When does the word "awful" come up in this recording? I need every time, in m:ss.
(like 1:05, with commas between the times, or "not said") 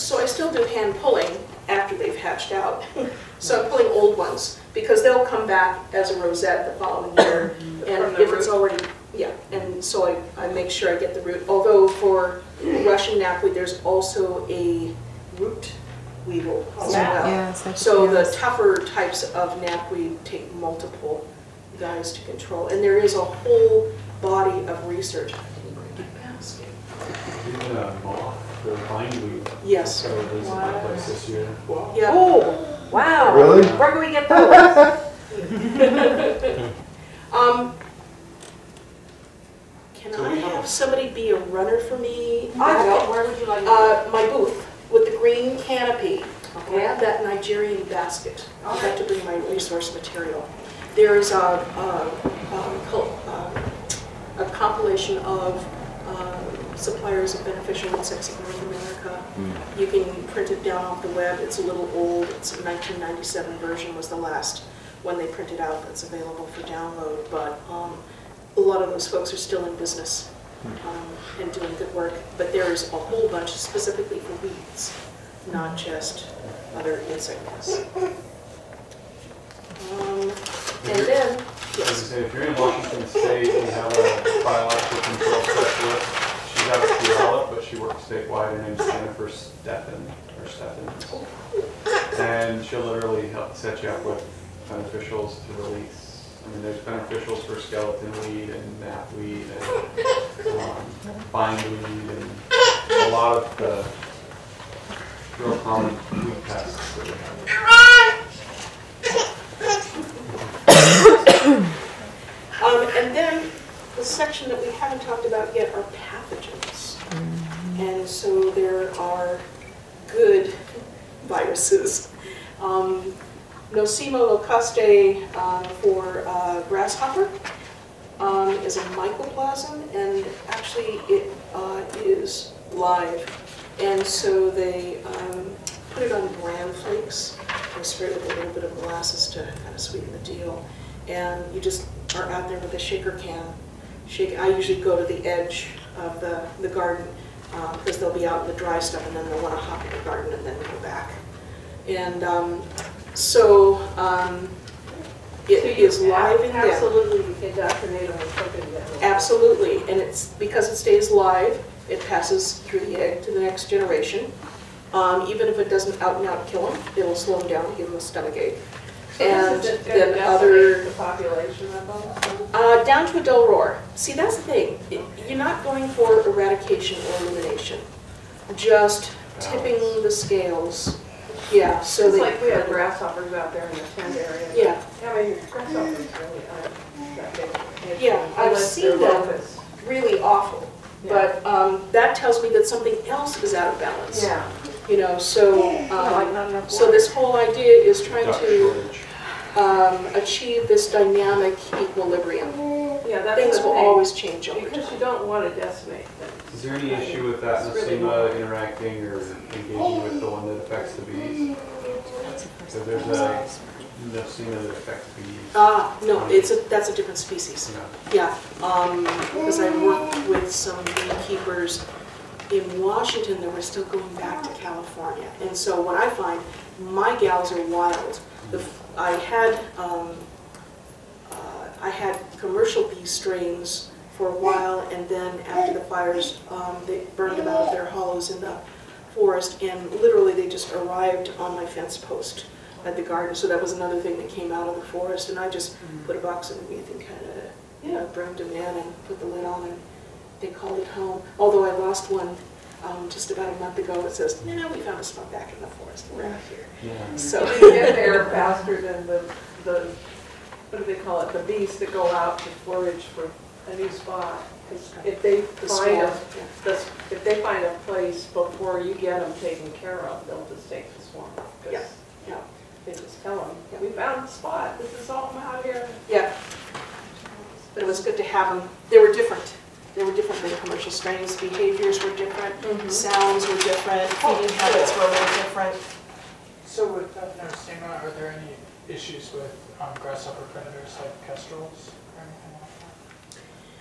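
3:10.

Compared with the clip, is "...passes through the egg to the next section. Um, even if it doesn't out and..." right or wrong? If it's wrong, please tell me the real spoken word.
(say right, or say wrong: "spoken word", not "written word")
wrong: "generation", not "section".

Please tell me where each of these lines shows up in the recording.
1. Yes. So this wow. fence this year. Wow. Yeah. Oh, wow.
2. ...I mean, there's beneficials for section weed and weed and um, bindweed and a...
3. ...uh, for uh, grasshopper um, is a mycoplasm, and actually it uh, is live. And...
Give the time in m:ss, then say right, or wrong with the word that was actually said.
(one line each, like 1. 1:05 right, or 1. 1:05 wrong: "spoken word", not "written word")
1. 0:29 wrong: "place", not "fence"
2. 1:36 wrong: "skeleton", not "section"
3. 2:05 right.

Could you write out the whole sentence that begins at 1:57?
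And so there are good viruses.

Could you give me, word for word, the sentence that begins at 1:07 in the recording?
But um, a lot of those folks are still in business um, and doing good work.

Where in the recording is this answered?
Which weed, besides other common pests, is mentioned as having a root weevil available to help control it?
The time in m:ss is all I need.
0:12.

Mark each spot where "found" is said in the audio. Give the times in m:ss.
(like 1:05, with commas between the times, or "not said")
4:14, 4:33.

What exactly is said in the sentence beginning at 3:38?
Yeah, um, because I worked with some beekeepers in Washington that were still going back to California.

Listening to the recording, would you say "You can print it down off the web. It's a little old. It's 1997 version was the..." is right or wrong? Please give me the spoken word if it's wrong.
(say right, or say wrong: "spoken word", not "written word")
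right.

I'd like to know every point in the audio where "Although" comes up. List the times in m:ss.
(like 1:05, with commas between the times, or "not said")
0:11, 4:11.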